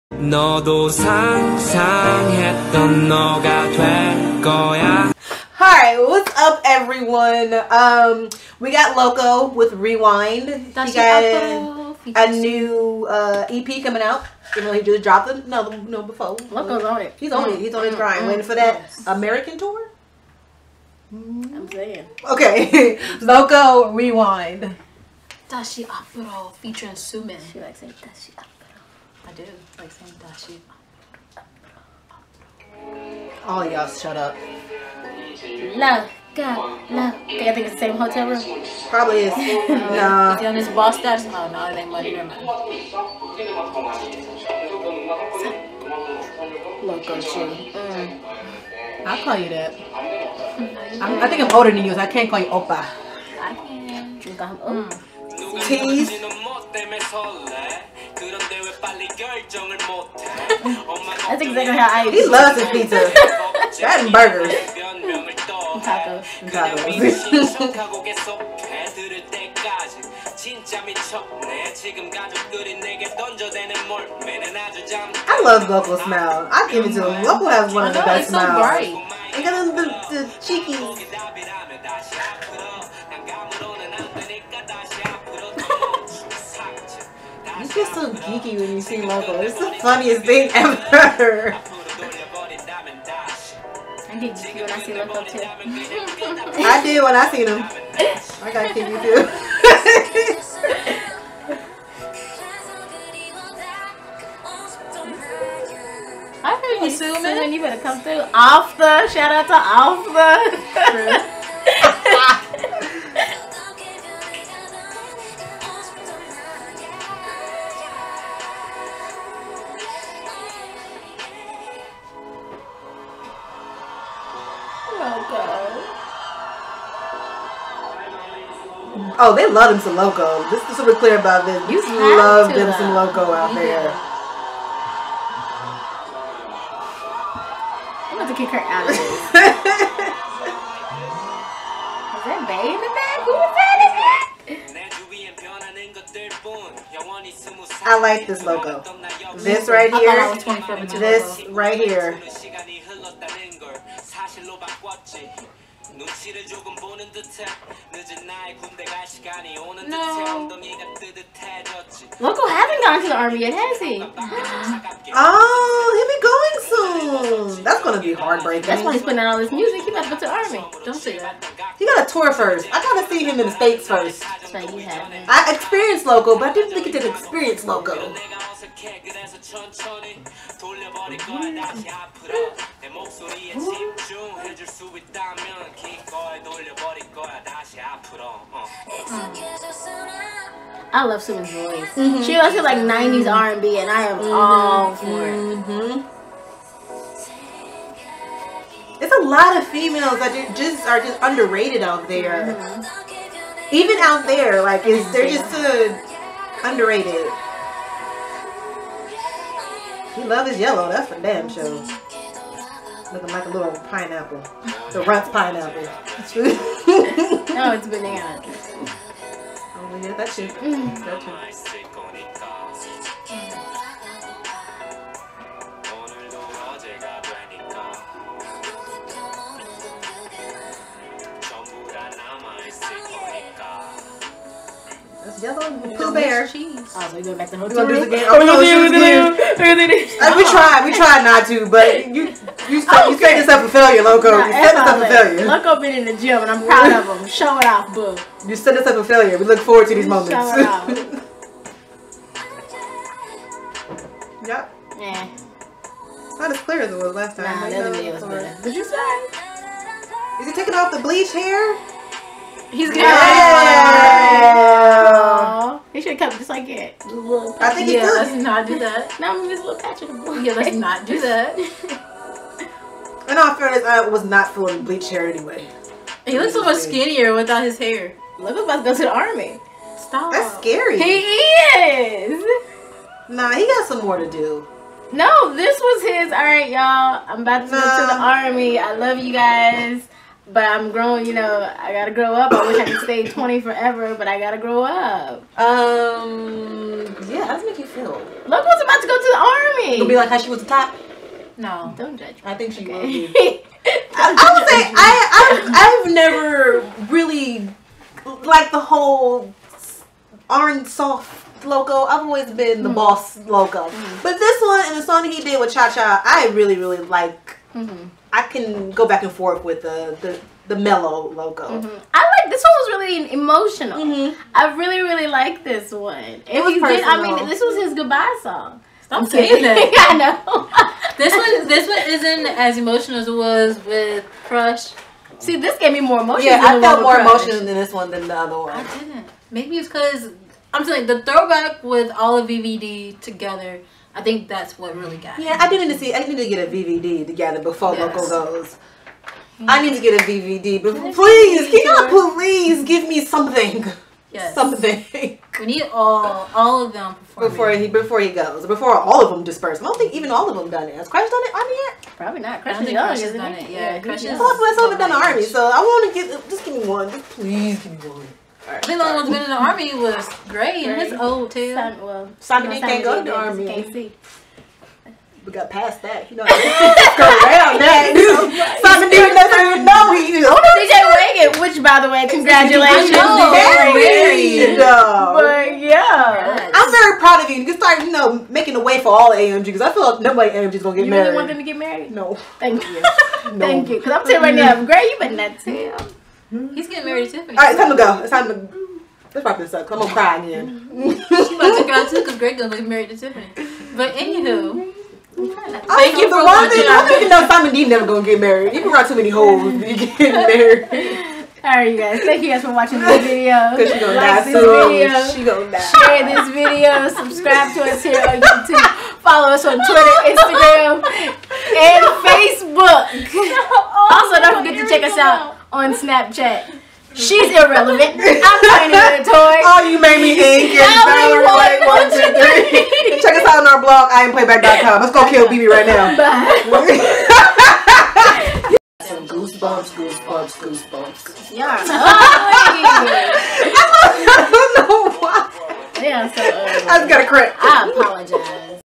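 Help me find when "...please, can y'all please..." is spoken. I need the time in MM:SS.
05:51.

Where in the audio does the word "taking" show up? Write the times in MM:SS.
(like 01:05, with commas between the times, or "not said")
04:20.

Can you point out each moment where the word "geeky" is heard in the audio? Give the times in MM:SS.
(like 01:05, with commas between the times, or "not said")
01:28, 01:38.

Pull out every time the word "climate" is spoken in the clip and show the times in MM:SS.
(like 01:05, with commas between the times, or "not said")
not said.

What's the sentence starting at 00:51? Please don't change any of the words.
I'm, I think I'm older than you, so I can't call you Oppa.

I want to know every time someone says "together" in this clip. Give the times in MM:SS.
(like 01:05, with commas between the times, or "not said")
05:43, 05:47.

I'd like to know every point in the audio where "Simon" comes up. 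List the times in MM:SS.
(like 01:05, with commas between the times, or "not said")
06:12, 06:18, 06:47.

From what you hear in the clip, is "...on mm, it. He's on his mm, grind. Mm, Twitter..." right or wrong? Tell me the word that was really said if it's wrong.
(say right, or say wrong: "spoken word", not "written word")
wrong: "Waiting", not "Twitter".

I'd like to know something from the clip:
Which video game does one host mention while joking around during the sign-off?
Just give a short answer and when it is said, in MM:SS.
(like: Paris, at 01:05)
Valorant, at 07:11.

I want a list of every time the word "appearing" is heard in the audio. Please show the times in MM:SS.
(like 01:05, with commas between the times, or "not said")
not said.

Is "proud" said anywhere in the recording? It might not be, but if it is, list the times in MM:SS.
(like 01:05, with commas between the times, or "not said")
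04:06, 06:27.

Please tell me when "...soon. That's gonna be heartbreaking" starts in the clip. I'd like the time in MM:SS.
02:46.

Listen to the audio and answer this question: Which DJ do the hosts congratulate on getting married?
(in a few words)
DJ Wegun.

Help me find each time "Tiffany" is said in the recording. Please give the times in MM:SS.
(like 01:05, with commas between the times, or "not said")
06:37, 06:43.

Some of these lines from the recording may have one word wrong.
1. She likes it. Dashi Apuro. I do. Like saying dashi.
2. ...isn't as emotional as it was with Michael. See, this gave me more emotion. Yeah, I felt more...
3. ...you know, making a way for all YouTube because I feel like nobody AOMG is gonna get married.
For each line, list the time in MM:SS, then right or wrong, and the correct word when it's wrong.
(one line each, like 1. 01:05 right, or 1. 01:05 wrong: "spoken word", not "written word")
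1. 00:27 right
2. 05:32 wrong: "Crush", not "Michael"
3. 06:28 wrong: "AOMG", not "YouTube".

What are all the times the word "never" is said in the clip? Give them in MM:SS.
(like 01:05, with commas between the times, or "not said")
00:42, 05:06, 06:47.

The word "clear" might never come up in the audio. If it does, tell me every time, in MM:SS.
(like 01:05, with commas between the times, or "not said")
02:10, 04:16.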